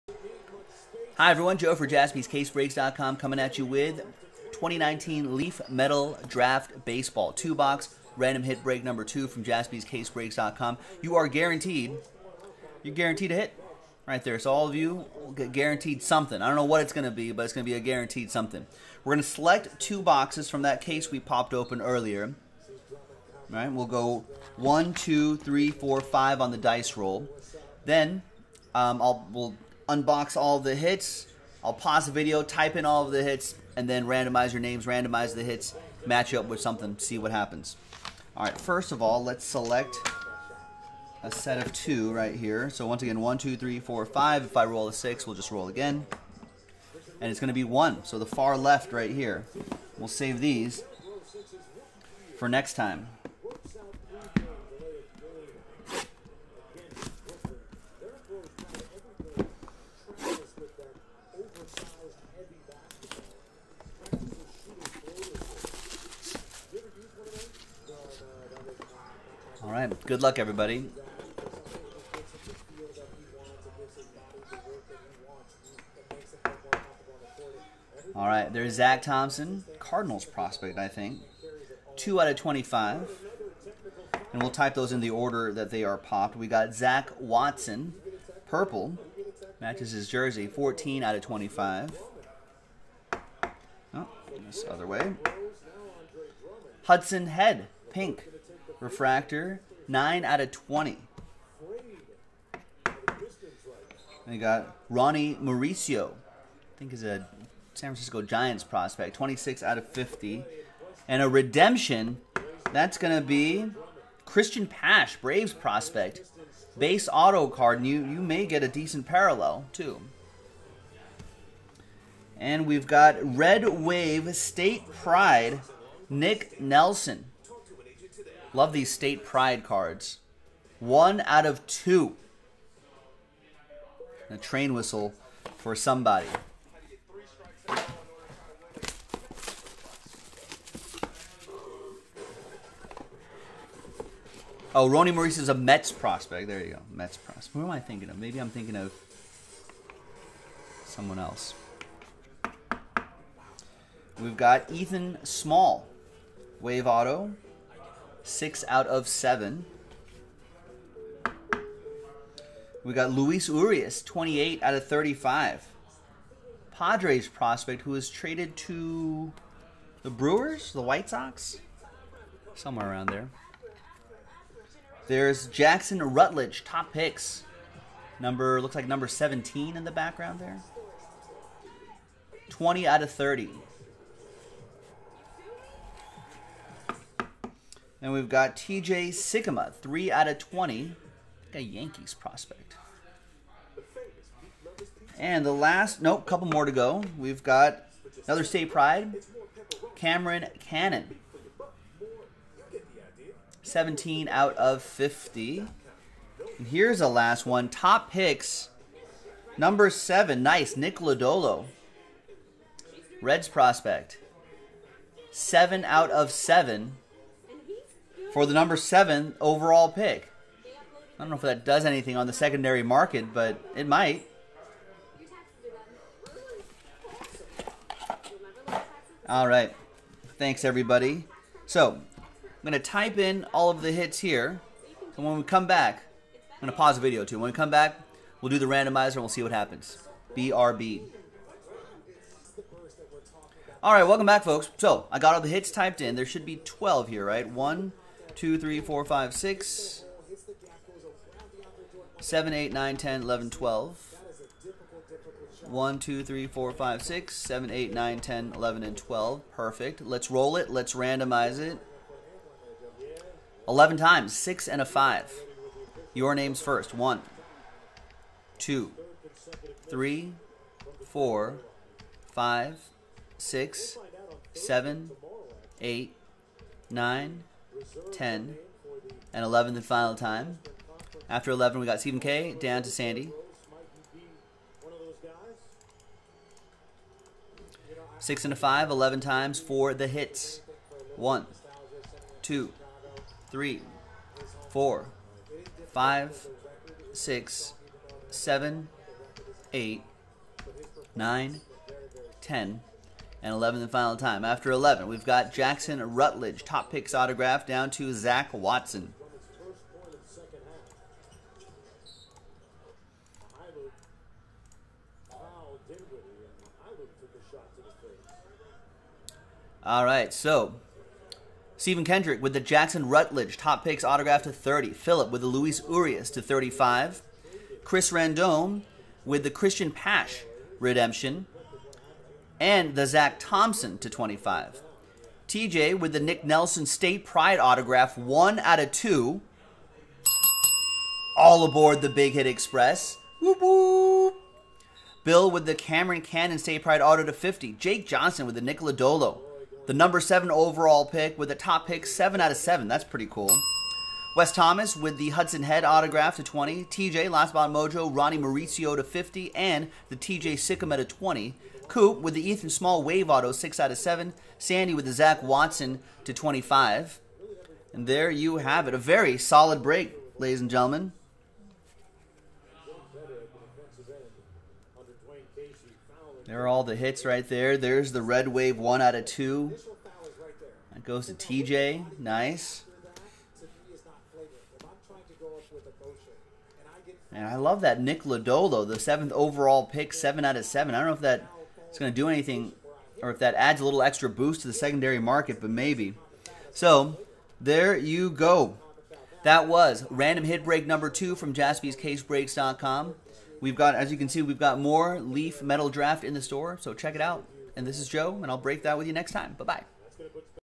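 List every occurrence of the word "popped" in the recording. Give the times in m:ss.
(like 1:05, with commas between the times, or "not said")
0:21, 1:25.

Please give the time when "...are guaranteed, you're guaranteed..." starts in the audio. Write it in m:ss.
0:11.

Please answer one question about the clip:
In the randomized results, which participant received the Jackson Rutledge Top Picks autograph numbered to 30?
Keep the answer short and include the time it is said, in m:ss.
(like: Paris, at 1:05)
Stephen Kendrick, at 5:21.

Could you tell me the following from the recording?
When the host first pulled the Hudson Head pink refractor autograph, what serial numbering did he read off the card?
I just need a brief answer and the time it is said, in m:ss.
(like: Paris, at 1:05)
9 out of 20, at 1:39.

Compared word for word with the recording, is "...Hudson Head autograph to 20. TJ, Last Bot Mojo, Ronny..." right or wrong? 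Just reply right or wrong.
right.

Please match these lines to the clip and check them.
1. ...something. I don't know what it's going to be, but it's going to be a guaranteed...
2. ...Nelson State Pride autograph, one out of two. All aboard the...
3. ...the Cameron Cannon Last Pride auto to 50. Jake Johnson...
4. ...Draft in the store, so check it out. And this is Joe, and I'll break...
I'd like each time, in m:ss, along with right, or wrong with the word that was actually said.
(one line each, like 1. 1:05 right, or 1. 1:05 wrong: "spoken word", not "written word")
1. 0:16 right
2. 5:36 right
3. 5:45 wrong: "State", not "Last"
4. 6:45 right.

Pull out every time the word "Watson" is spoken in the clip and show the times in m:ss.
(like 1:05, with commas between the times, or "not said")
1:27, 5:08, 6:05.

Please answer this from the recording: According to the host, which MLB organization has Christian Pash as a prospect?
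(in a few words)
Braves.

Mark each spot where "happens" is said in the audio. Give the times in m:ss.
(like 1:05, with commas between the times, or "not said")
0:37, 3:59.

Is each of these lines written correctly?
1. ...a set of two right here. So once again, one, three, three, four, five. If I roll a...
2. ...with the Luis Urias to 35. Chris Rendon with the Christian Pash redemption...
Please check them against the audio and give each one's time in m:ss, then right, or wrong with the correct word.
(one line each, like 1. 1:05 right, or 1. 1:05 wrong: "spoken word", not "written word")
1. 0:41 wrong: "two", not "three"
2. 5:25 right.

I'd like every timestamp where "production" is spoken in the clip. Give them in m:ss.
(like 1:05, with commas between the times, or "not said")
not said.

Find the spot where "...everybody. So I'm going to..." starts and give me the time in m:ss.
3:50.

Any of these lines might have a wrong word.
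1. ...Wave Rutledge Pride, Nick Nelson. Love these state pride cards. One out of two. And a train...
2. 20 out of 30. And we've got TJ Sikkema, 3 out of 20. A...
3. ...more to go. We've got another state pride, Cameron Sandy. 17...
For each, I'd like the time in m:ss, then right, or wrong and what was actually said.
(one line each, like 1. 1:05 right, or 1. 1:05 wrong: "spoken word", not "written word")
1. 2:03 wrong: "State", not "Rutledge"
2. 3:02 right
3. 3:16 wrong: "Cannon", not "Sandy".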